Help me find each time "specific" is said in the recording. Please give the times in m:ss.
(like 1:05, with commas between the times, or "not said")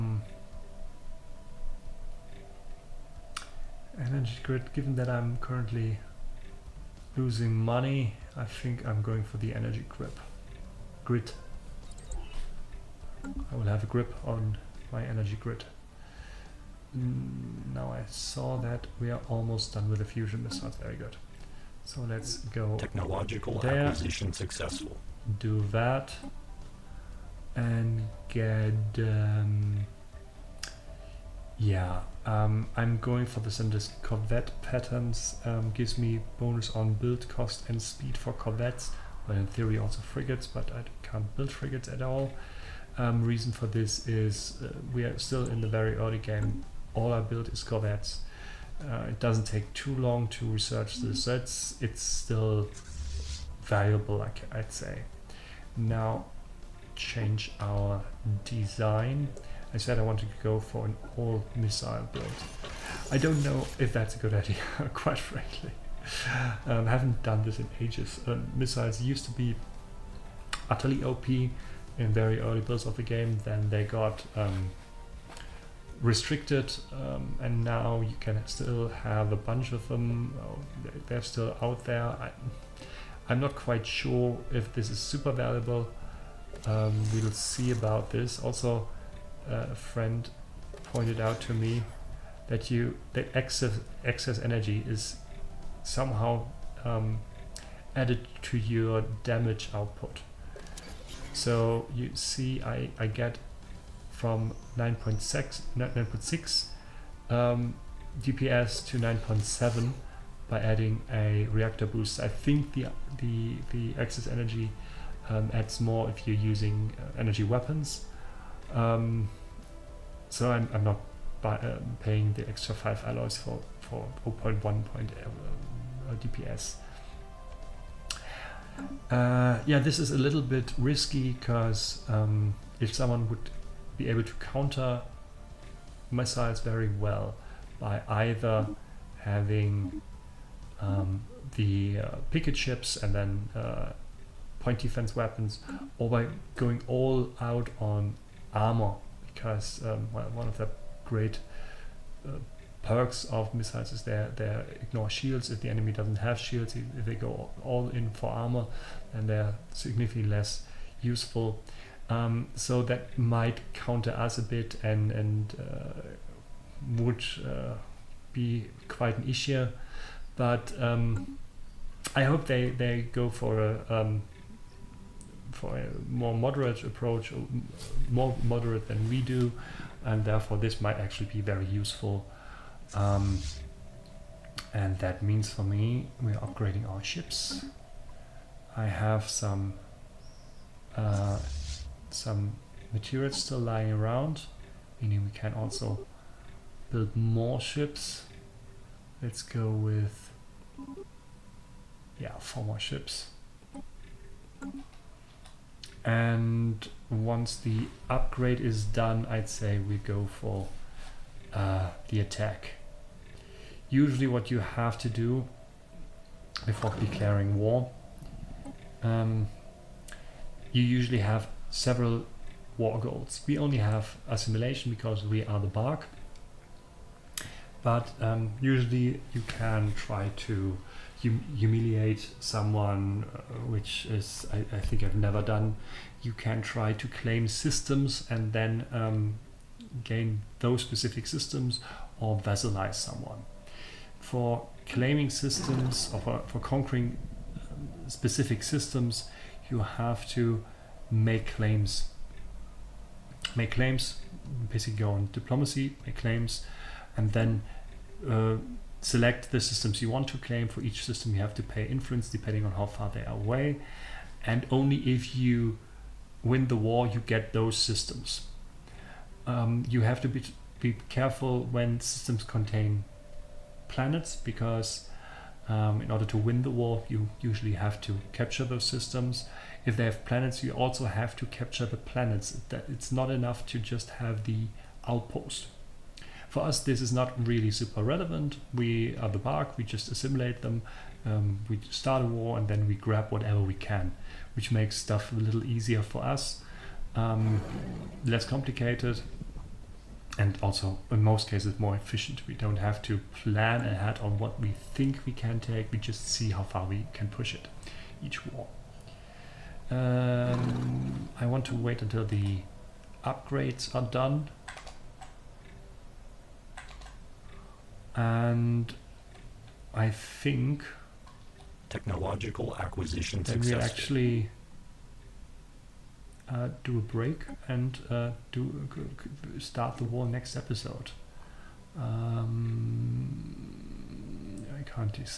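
4:00, 4:08.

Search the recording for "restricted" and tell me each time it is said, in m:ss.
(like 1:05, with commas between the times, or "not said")
1:16.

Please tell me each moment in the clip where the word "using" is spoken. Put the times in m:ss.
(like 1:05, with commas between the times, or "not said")
1:56.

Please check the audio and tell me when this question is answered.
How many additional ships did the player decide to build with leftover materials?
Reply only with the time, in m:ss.
3:22.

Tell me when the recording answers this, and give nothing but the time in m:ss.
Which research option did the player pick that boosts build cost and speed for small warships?
0:34.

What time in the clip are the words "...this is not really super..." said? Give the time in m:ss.
4:46.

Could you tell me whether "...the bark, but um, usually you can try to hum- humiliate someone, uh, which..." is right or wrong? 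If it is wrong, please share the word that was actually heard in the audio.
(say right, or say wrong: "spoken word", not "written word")
right.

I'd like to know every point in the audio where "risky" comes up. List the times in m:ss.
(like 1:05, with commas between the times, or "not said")
2:10.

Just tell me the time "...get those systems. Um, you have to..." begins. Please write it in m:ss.
4:27.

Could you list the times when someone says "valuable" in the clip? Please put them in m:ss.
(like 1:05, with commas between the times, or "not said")
0:53, 1:25.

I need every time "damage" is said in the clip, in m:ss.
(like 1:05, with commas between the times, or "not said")
1:39.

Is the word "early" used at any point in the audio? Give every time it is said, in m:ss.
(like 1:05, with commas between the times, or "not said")
0:45, 1:12.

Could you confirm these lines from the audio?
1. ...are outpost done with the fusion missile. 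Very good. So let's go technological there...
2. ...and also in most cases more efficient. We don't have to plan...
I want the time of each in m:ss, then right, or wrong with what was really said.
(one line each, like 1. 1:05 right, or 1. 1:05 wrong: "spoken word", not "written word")
1. 0:19 wrong: "almost", not "outpost"
2. 5:00 right.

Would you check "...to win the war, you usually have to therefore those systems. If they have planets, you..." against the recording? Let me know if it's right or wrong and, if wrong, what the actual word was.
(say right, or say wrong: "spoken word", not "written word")
wrong: "capture", not "therefore".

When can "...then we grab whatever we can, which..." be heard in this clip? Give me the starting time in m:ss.
4:52.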